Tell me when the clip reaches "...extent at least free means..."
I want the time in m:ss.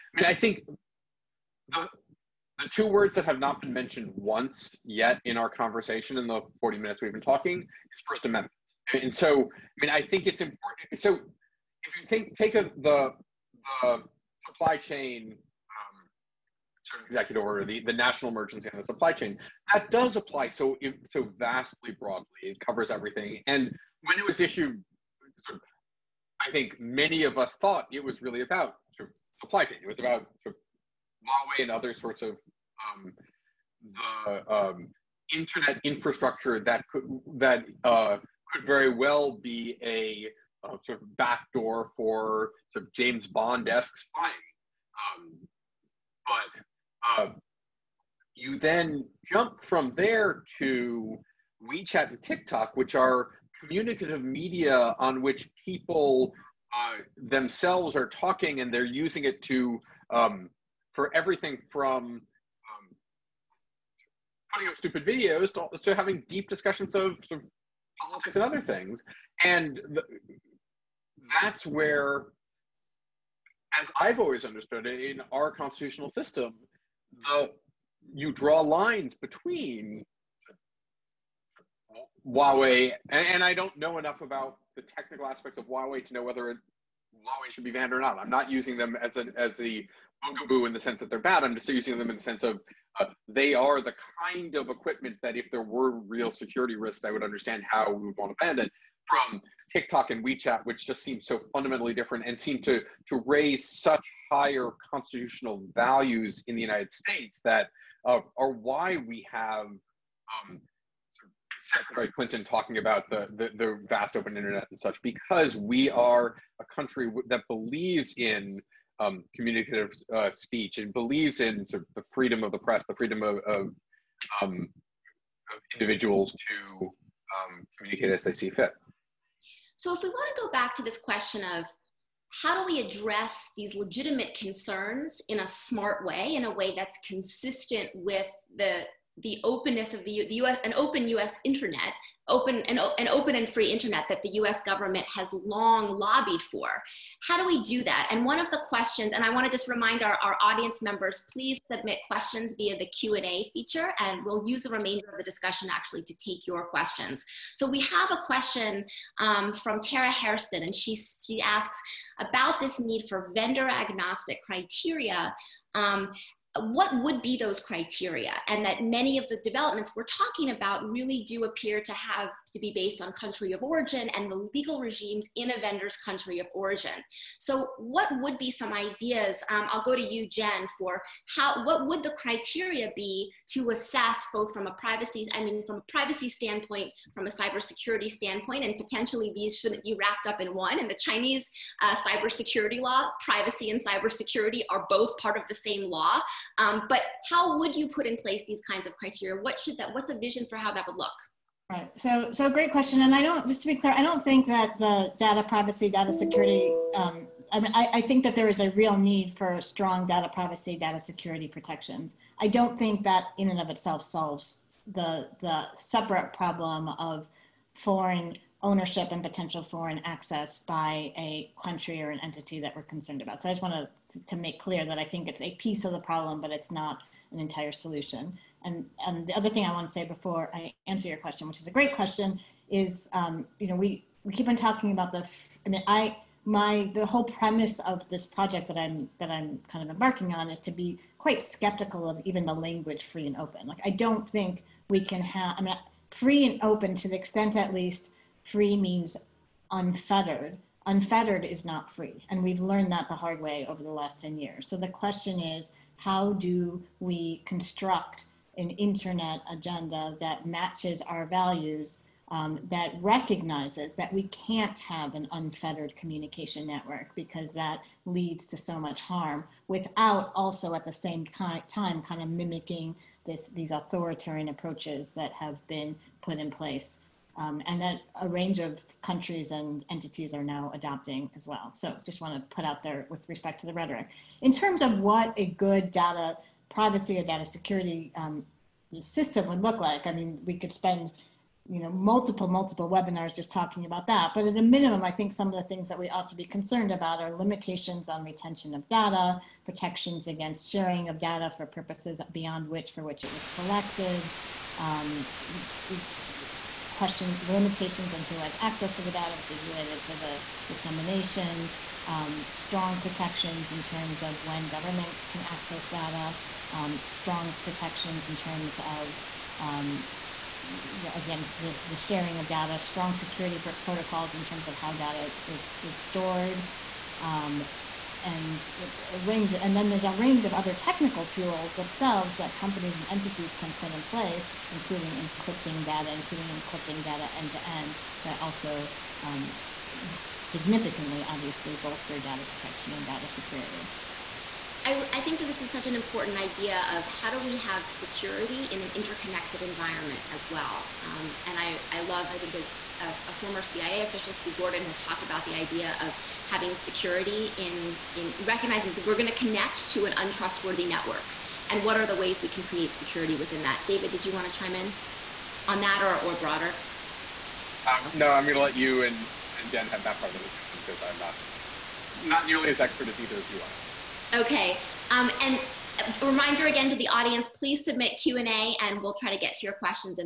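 4:07.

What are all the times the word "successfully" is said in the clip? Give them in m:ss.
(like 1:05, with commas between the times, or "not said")
not said.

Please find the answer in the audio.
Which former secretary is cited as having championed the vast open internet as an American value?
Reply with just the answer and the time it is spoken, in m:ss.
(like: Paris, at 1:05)
Secretary Clinton, at 1:51.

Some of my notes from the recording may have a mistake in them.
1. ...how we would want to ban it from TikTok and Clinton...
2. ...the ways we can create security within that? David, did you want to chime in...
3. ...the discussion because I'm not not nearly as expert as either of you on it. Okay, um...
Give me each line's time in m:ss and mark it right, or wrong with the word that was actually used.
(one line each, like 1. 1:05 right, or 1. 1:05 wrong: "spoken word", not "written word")
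1. 1:37 wrong: "WeChat", not "Clinton"
2. 6:02 right
3. 6:10 right.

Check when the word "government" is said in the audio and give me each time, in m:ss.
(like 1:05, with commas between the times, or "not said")
2:24, 5:14.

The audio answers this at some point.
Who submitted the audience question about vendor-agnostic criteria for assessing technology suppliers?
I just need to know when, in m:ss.
2:39.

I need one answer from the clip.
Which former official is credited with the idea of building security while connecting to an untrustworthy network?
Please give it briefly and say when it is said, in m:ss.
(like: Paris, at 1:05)
Sue Gordon, at 5:54.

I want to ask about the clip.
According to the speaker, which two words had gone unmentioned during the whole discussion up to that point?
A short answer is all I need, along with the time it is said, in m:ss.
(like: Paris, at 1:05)
First Amendment, at 0:08.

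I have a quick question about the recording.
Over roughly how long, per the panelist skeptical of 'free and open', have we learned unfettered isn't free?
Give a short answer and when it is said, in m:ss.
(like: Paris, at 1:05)
10 years, at 4:14.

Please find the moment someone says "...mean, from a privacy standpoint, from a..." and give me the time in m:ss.
3:05.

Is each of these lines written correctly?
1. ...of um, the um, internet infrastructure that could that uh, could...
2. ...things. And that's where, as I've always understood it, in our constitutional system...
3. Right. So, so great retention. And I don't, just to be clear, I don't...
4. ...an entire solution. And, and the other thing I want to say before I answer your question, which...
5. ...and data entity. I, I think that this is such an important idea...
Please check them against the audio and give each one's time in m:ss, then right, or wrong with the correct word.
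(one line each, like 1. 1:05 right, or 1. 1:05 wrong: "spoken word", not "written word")
1. 0:32 right
2. 1:08 right
3. 3:21 wrong: "question", not "retention"
4. 3:47 right
5. 5:42 wrong: "security", not "entity".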